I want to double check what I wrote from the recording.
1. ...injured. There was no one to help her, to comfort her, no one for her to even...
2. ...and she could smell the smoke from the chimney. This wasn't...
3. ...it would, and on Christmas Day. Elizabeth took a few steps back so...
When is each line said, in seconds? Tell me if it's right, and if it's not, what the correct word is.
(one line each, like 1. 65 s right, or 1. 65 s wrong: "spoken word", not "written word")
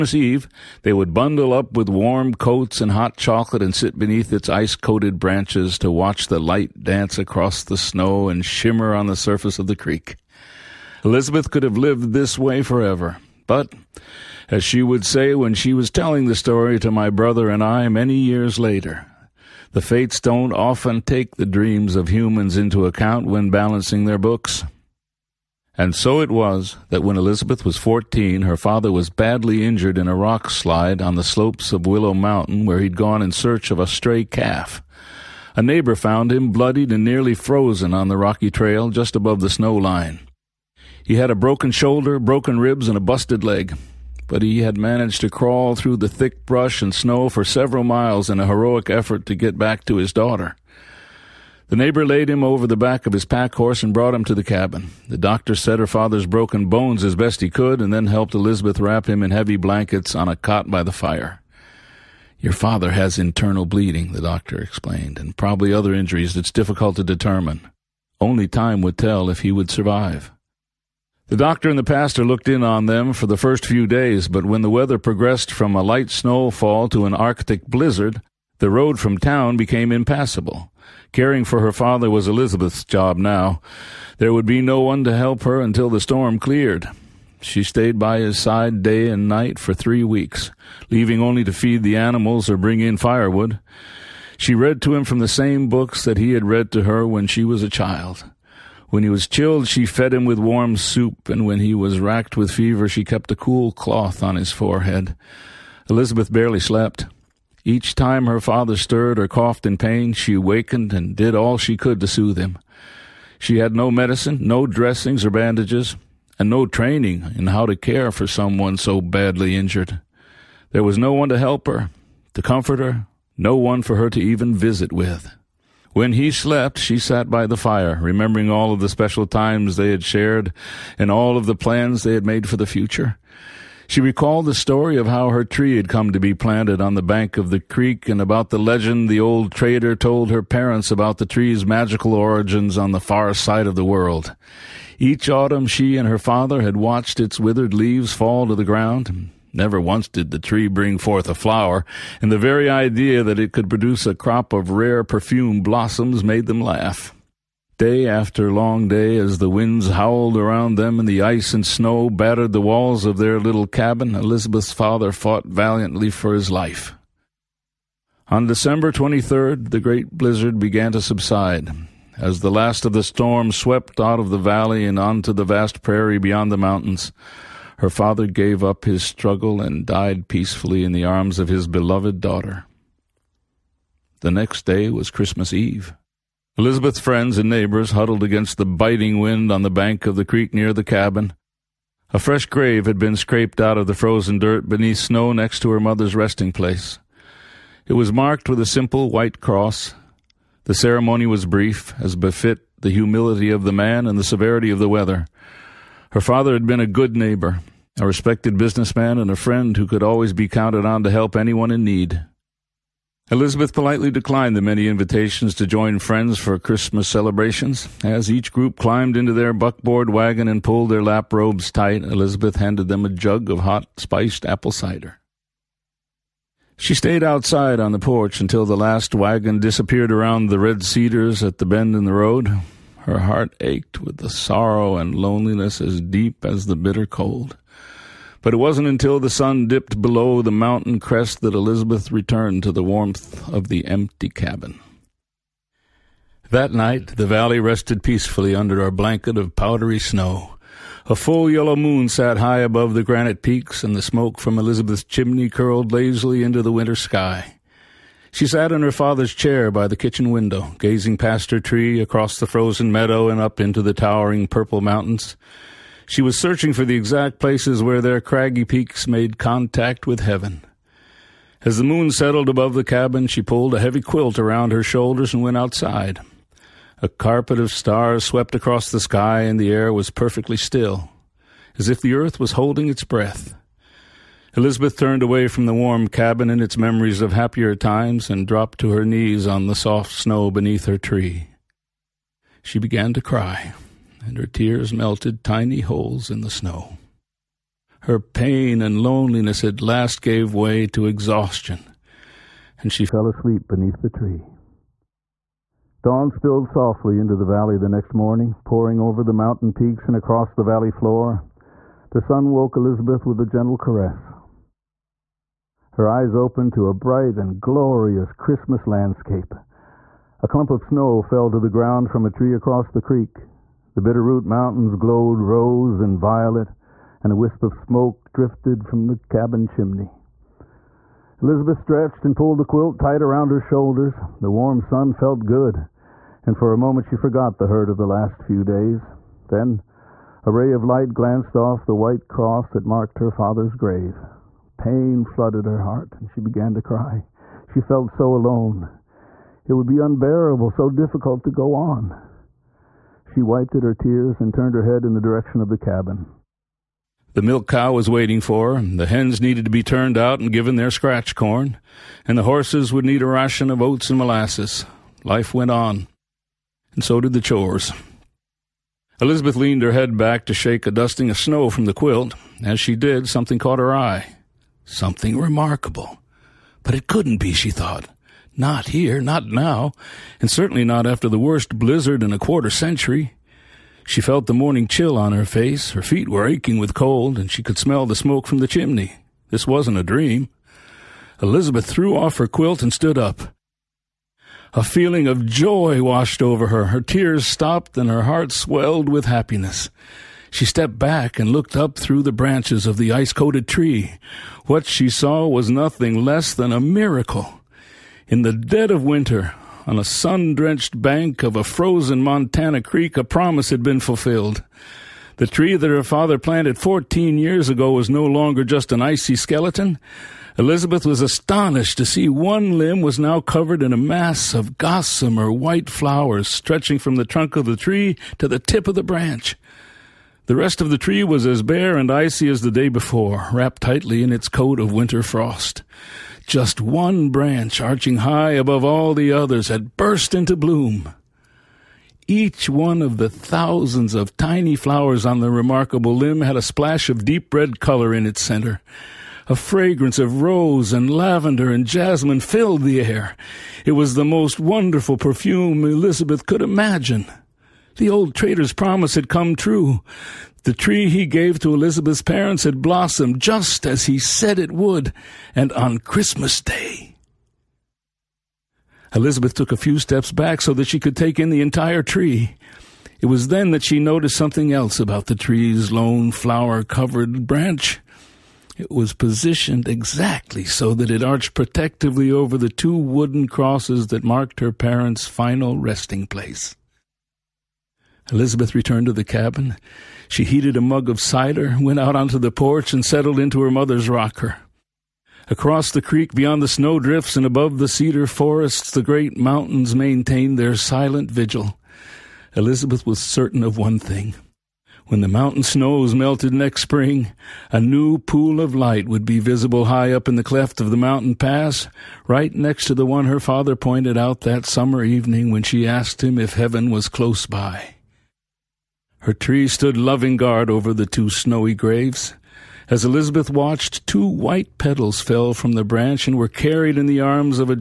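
1. 119 s right
2. 387 s right
3. 464 s right.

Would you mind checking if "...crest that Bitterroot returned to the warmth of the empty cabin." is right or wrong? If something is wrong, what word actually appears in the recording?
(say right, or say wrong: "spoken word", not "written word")
wrong: "Elizabeth", not "Bitterroot".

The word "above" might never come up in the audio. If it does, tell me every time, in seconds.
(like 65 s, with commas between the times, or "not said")
39 s, 252 s, 272 s, 438 s, 497 s.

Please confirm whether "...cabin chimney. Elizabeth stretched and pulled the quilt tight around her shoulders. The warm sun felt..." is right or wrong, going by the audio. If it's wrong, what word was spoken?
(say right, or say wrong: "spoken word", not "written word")
right.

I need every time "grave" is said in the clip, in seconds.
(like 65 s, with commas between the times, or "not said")
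192 s, 343 s, 521 s.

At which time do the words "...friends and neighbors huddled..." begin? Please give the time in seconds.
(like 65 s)
187 s.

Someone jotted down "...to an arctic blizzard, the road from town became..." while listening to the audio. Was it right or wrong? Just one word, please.
right.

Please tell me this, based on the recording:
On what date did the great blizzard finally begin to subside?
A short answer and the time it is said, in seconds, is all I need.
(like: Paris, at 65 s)
December 23, at 168 s.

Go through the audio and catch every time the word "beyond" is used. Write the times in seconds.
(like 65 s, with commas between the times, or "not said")
176 s, 496 s.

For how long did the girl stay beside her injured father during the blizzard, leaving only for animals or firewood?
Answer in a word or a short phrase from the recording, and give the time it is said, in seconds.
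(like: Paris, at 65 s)
three weeks, at 89 s.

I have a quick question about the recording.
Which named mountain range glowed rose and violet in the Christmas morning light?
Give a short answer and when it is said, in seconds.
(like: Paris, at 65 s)
Bitterroot Mountains, at 324 s.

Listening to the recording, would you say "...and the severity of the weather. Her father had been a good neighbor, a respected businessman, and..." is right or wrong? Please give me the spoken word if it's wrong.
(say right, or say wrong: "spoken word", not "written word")
right.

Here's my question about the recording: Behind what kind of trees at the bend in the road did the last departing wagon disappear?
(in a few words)
red cedars.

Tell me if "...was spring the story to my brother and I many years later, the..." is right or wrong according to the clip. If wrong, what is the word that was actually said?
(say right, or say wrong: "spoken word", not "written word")
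wrong: "telling", not "spring".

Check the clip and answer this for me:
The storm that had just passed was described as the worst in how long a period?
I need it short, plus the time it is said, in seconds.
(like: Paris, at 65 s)
a quarter century, at 382 s.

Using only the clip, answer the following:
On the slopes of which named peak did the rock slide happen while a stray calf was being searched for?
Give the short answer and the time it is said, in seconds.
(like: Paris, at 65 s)
Willow Mountain, at 31 s.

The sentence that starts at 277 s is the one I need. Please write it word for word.
A carpet of stars swept across the sky, and the air was perfectly still, as if the earth was holding its breath.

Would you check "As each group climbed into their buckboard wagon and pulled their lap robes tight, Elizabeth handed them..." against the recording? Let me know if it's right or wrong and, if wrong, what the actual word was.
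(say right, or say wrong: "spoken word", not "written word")
right.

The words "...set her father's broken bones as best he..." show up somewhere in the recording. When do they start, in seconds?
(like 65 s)
55 s.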